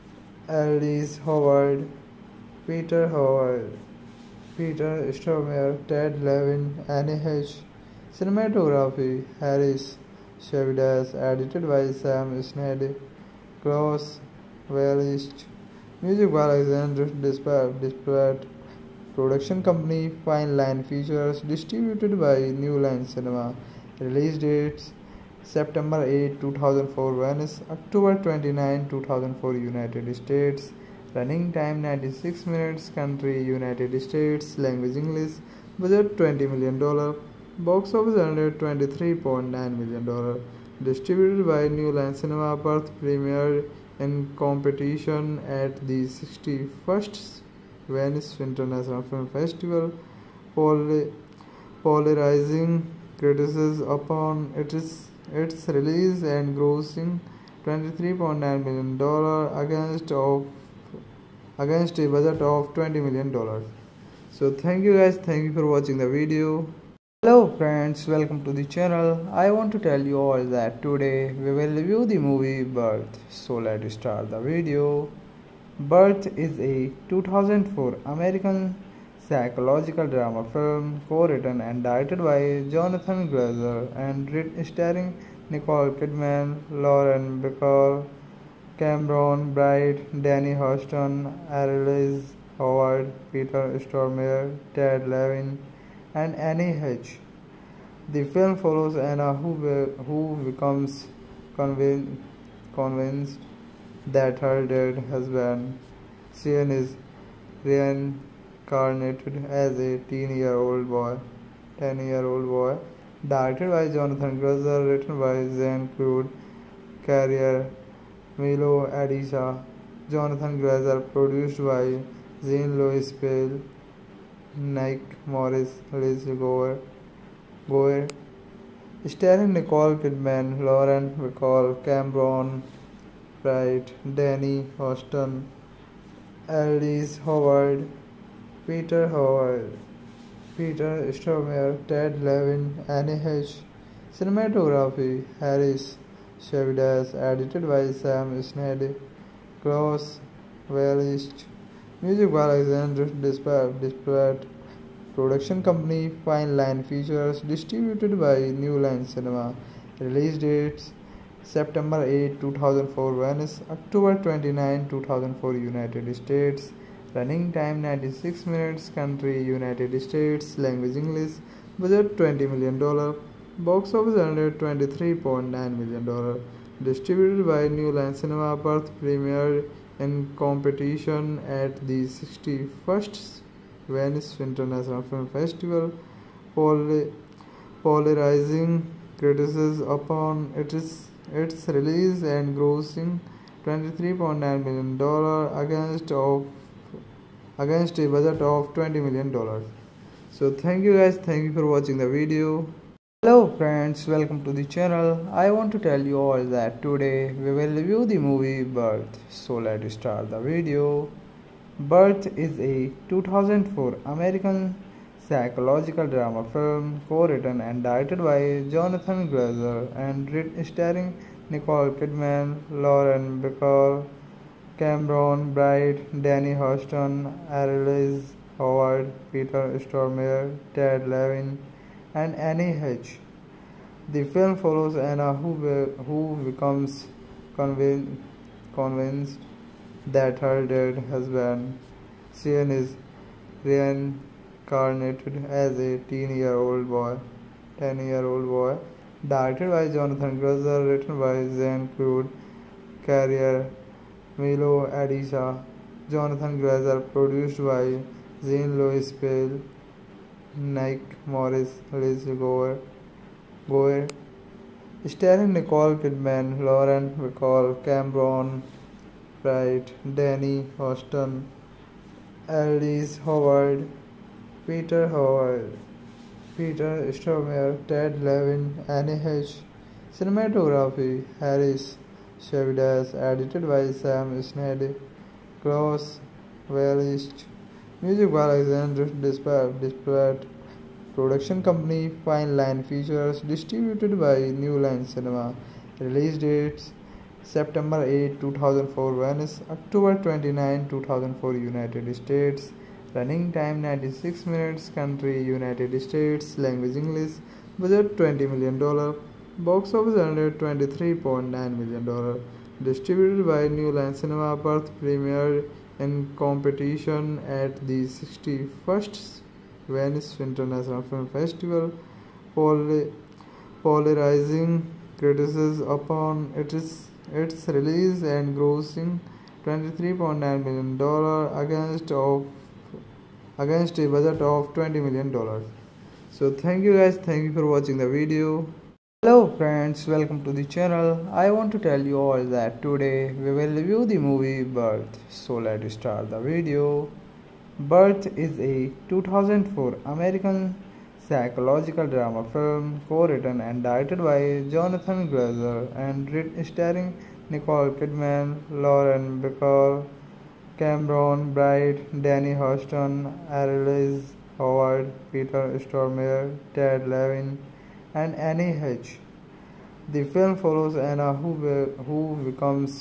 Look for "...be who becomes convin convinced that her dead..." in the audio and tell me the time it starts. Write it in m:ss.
1:39.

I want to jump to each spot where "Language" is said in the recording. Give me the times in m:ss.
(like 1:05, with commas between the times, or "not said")
0:34, 2:50, 5:06.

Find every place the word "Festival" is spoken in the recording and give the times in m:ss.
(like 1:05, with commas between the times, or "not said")
0:49, 3:05, 5:21.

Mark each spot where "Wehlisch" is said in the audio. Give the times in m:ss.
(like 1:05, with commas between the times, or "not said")
0:14, 2:30, 4:46.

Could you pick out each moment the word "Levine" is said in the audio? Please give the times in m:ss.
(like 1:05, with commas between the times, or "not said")
0:06, 1:35, 2:22, 3:51, 4:38, 6:07.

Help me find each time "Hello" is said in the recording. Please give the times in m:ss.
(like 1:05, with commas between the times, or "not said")
1:07, 3:23, 5:39.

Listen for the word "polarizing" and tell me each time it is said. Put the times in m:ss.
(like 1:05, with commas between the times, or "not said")
0:51, 3:07, 5:23.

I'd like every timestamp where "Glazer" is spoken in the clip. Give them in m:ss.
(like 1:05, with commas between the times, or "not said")
1:23, 1:54, 2:00, 3:39, 4:10, 4:16, 5:55.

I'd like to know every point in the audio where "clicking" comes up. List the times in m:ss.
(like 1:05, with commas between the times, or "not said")
not said.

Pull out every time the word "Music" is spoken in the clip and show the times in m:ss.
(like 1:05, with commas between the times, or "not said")
0:16, 2:32, 4:48.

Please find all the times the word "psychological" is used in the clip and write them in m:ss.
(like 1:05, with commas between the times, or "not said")
1:19, 3:35, 5:51.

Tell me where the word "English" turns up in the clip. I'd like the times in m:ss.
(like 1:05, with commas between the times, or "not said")
0:34, 2:50, 5:06.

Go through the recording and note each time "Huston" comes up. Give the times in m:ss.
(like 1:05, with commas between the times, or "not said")
1:30, 2:14, 3:46, 4:30, 6:02.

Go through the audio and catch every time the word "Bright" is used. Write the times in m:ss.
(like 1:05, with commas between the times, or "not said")
1:29, 2:13, 3:45, 4:29, 6:01.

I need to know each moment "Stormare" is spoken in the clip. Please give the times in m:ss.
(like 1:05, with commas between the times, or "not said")
0:05, 1:33, 2:21, 3:49, 4:37, 6:05.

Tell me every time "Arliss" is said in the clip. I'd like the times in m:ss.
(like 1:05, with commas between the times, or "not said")
0:00, 1:31, 2:16, 3:47, 4:32, 6:03.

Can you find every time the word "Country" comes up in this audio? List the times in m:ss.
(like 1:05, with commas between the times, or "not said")
0:32, 2:48, 5:04.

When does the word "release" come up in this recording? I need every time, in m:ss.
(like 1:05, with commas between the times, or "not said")
0:23, 0:55, 2:39, 3:11, 4:55, 5:27.